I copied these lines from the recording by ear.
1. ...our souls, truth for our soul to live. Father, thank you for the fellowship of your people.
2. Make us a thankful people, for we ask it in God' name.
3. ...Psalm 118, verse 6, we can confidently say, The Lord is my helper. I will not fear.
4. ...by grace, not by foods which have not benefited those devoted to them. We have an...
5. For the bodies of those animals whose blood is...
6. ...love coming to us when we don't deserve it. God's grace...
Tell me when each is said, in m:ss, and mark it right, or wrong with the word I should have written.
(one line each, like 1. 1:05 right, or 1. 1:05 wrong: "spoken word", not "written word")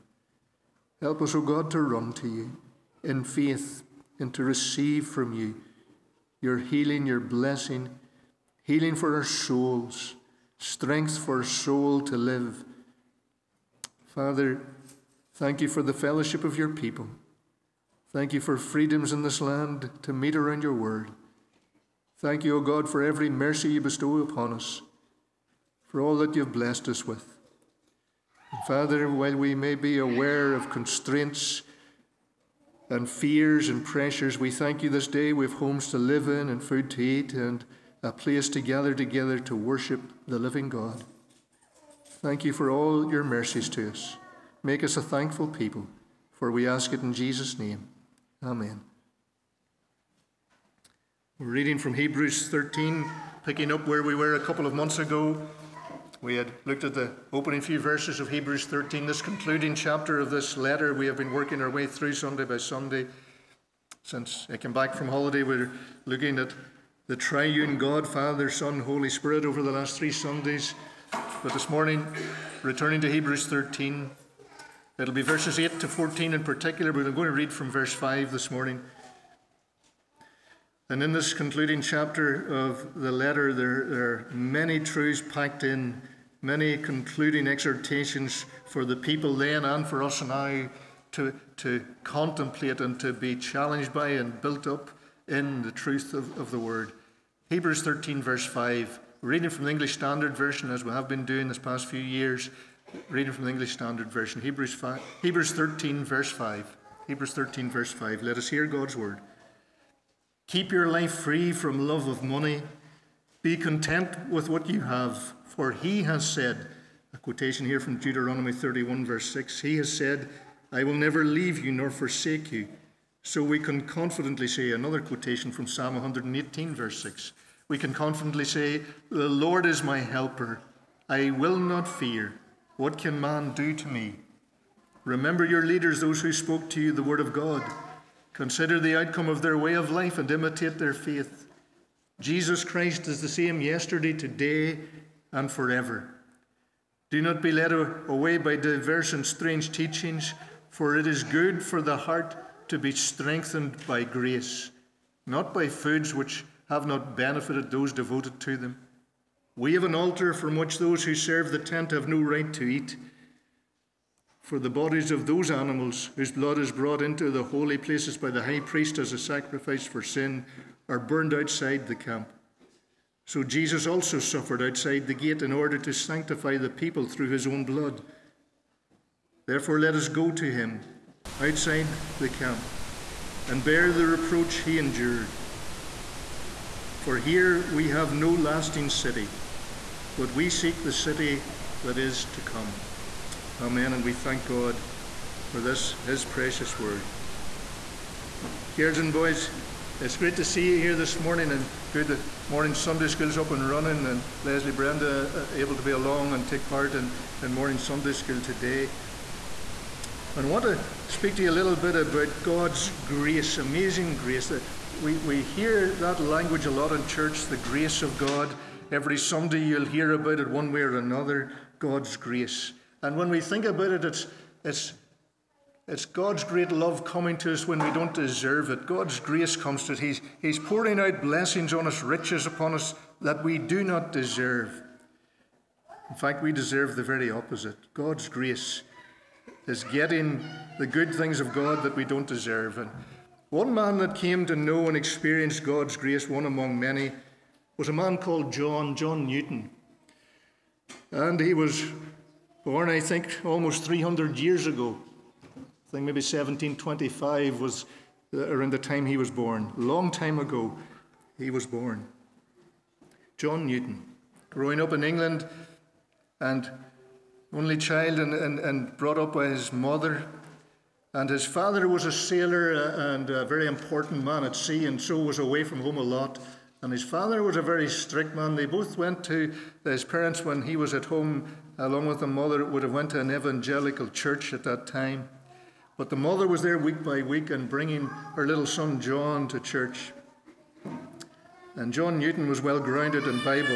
1. 0:09 wrong: "strength", not "truth"
2. 0:44 wrong: "Jesus", not "God"
3. 2:05 right
4. 2:33 right
5. 2:44 right
6. 3:46 right.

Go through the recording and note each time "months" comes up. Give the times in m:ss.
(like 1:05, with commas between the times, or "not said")
0:54.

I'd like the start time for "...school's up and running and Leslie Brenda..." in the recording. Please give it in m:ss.
3:23.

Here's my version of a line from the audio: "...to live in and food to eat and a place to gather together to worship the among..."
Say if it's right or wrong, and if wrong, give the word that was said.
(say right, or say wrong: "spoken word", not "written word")
wrong: "living", not "among".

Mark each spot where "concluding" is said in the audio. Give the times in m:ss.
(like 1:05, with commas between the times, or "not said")
0:59, 1:21, 1:26.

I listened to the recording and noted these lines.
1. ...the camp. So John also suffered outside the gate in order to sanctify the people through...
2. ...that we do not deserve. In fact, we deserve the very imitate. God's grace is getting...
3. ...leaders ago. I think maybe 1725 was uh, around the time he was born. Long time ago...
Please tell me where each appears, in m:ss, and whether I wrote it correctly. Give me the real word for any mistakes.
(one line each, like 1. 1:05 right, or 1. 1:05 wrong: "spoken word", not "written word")
1. 2:51 wrong: "Jesus", not "John"
2. 3:53 wrong: "opposite", not "imitate"
3. 4:14 wrong: "years", not "leaders".